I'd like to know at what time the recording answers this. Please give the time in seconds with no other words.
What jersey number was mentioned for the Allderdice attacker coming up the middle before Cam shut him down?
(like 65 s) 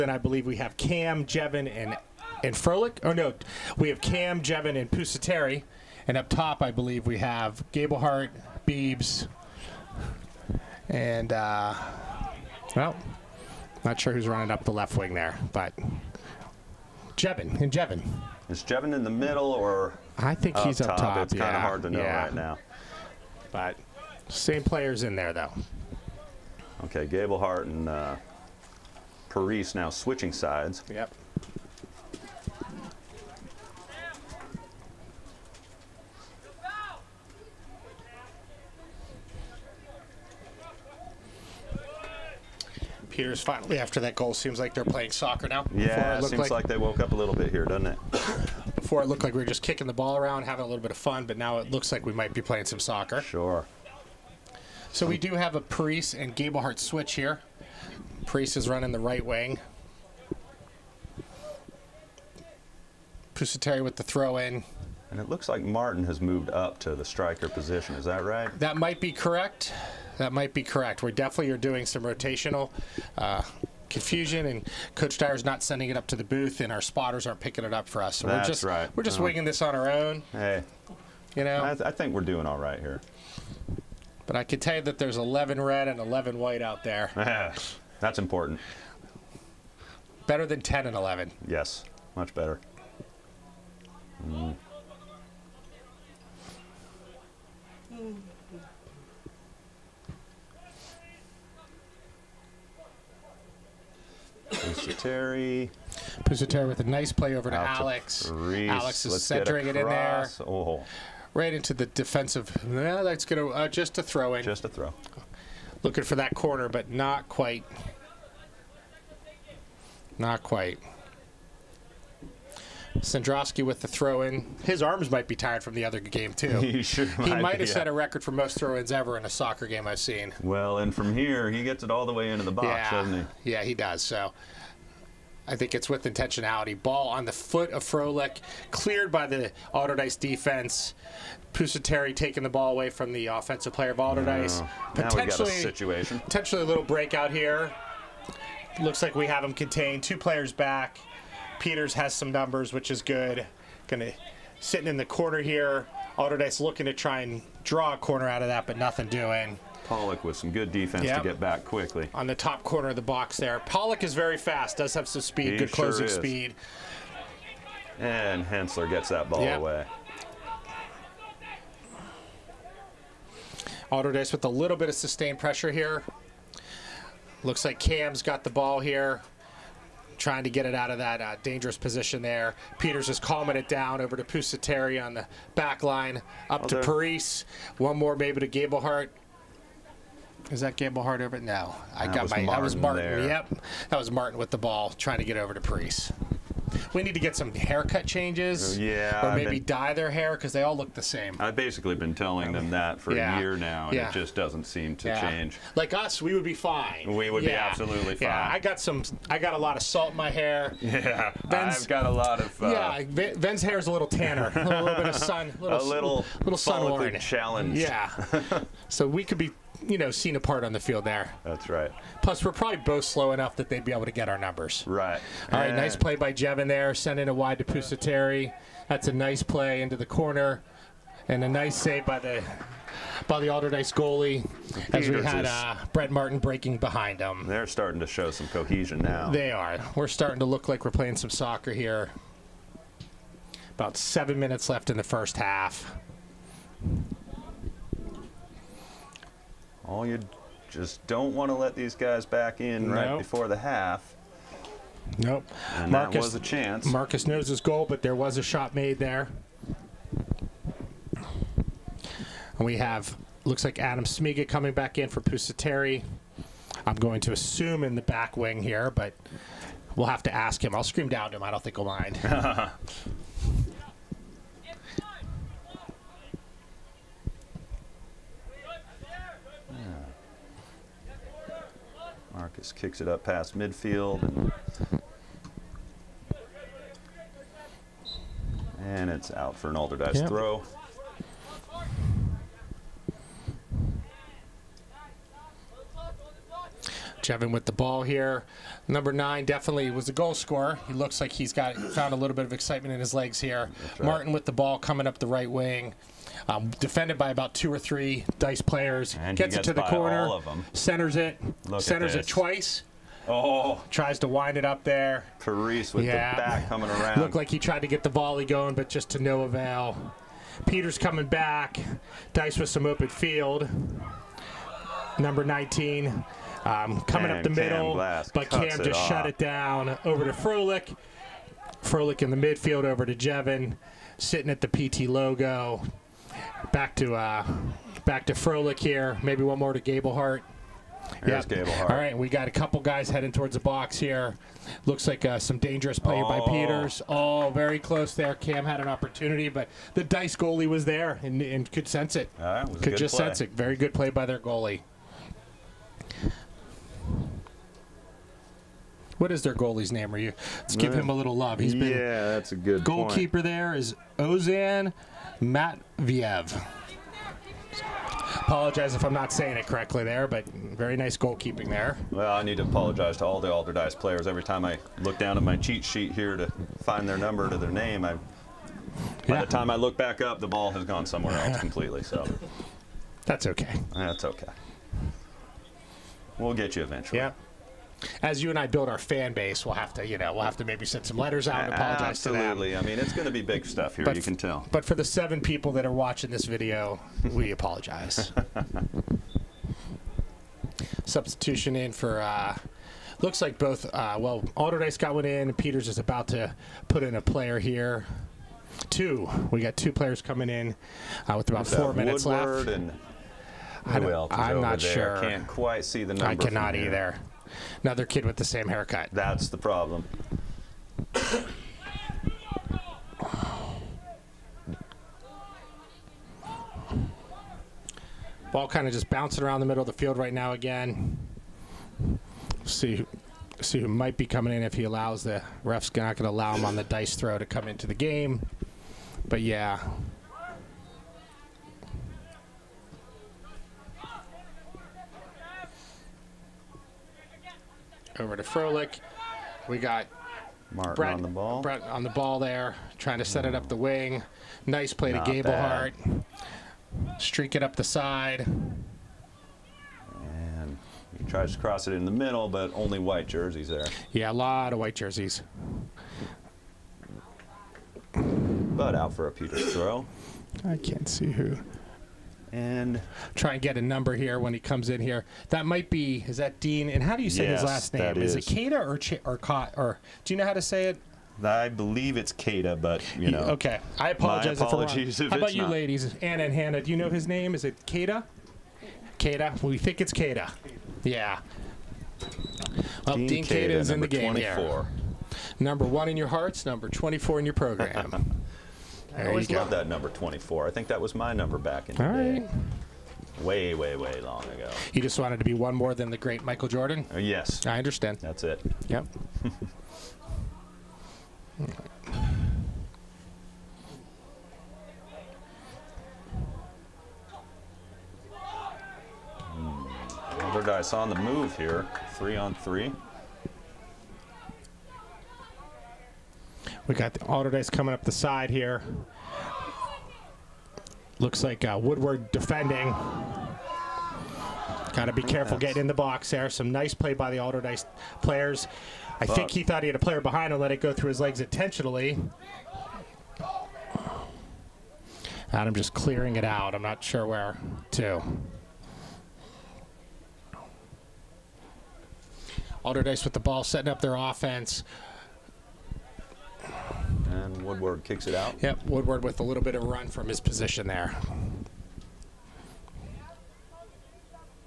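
325 s.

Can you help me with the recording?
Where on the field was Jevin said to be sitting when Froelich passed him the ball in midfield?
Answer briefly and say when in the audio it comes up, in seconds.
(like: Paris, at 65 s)
PT logo, at 334 s.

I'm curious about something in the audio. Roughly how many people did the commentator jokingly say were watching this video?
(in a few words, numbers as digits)
7.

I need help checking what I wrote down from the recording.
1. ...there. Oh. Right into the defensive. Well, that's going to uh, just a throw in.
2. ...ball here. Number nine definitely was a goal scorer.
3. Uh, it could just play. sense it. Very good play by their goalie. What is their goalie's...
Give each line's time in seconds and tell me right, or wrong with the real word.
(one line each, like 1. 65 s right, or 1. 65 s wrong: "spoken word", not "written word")
1. 109 s right
2. 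297 s right
3. 352 s right.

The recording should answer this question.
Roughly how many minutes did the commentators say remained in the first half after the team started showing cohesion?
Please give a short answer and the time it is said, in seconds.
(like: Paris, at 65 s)
7, at 243 s.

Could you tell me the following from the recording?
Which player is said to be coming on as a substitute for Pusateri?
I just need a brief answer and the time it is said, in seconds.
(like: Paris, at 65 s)
Adam Smiga, at 263 s.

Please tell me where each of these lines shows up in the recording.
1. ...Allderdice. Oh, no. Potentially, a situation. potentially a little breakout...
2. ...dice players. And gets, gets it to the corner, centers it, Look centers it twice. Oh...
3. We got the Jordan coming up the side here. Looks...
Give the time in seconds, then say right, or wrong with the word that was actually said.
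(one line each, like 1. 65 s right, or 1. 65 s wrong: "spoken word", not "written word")
1. 143 s right
2. 308 s right
3. 526 s wrong: "Allderdice", not "Jordan".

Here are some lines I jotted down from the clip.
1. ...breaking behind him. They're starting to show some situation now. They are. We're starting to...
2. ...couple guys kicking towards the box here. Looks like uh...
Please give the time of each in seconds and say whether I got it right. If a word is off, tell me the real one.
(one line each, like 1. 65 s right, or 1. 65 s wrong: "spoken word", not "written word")
1. 236 s wrong: "cohesion", not "situation"
2. 342 s wrong: "heading", not "kicking".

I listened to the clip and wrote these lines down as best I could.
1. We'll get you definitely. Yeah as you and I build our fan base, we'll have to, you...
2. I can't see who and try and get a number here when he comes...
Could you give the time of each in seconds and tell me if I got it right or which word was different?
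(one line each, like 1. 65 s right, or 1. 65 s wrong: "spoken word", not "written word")
1. 386 s wrong: "eventually", not "definitely"
2. 470 s right.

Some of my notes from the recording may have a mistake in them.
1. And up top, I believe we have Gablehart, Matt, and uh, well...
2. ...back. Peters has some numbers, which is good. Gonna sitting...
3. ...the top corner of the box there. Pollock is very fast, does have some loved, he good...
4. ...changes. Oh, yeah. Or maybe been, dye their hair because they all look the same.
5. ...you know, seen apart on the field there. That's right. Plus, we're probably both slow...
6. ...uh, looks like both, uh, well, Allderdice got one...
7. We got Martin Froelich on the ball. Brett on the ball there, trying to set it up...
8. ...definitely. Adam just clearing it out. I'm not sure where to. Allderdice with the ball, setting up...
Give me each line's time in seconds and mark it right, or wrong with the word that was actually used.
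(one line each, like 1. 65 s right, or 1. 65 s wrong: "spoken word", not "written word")
1. 6 s wrong: "Biebs", not "Matt"
2. 150 s right
3. 162 s wrong: "speed", not "loved"
4. 198 s right
5. 219 s right
6. 402 s right
7. 449 s wrong: "Brett", not "Froelich"
8. 541 s wrong: "intentionally", not "definitely".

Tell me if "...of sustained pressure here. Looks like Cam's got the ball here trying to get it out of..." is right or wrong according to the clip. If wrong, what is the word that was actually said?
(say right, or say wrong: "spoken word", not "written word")
right.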